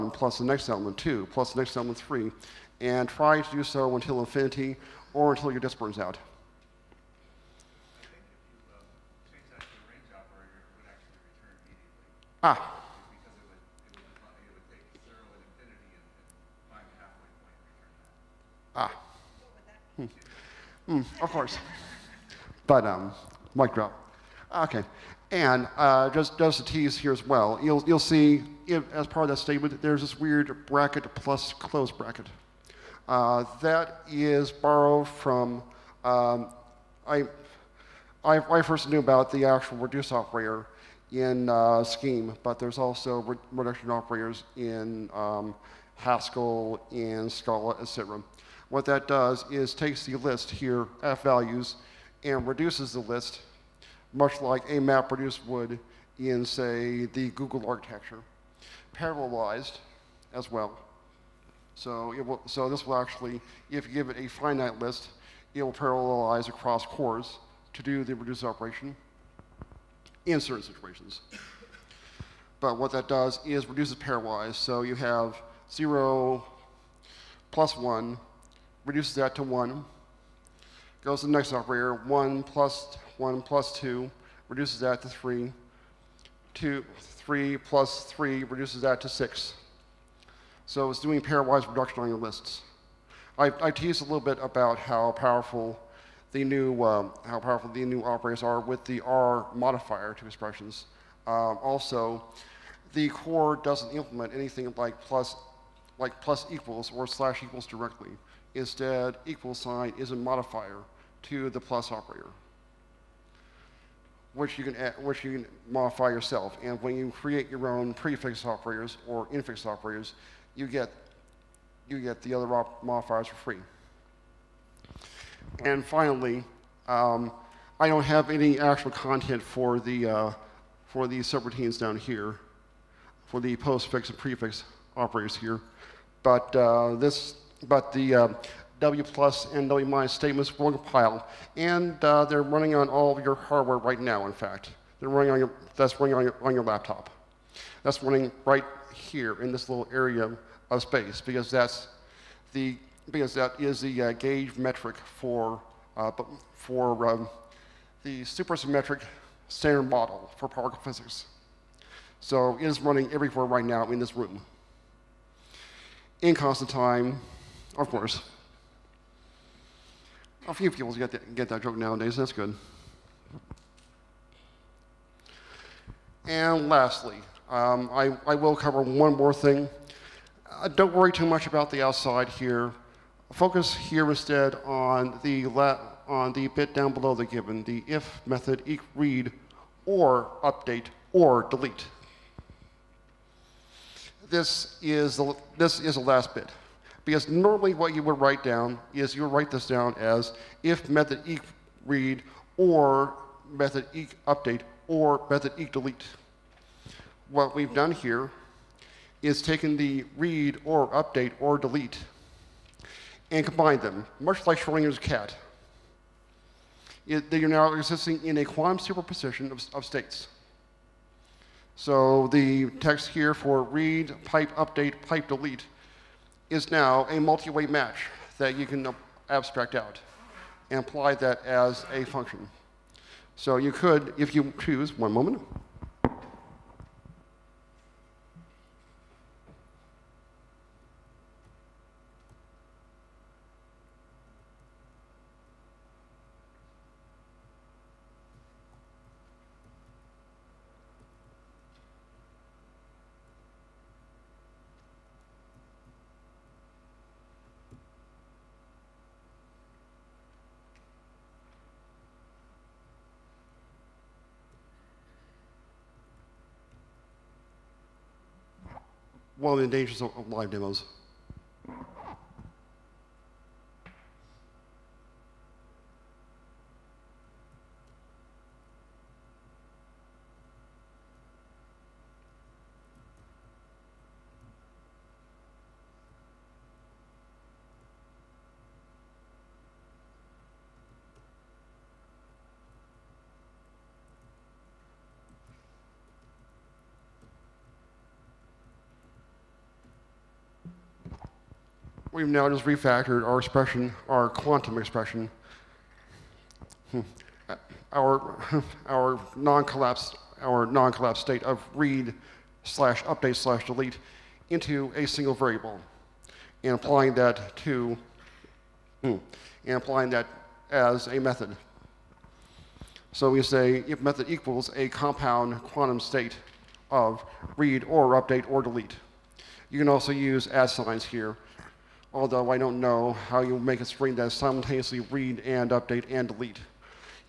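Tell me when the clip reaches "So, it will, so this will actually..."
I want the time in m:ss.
1:01.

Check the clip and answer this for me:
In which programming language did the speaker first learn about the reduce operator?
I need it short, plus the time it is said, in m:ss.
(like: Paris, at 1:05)
Scheme, at 0:41.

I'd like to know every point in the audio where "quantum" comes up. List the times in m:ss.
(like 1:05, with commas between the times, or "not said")
3:38, 5:04, 5:25.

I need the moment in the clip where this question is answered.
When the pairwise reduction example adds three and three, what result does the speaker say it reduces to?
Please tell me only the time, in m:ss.
1:29.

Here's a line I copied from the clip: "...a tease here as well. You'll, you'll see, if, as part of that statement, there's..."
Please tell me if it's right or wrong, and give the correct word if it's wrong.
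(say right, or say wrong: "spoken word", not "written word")
right.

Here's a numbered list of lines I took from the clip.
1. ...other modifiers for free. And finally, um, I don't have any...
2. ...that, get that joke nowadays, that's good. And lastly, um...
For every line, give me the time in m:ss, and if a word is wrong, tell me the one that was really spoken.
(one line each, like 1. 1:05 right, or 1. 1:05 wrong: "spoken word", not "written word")
1. 2:02 right
2. 2:51 right.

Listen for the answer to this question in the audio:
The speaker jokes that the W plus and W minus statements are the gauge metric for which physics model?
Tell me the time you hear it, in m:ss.
2:38.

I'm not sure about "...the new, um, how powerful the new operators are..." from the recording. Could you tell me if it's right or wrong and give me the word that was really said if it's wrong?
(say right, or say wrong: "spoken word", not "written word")
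right.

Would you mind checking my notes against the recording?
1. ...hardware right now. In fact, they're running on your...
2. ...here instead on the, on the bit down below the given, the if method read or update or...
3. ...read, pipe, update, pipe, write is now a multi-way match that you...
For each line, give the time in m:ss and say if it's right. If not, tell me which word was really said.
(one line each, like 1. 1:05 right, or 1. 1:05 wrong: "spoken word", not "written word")
1. 2:23 right
2. 3:03 right
3. 3:43 wrong: "delete", not "write".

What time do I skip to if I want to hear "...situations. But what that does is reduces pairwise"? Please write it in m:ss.
1:10.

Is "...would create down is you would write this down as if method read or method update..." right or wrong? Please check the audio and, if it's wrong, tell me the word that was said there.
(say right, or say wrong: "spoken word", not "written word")
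wrong: "write", not "create".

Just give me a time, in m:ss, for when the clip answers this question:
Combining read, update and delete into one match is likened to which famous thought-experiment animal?
3:34.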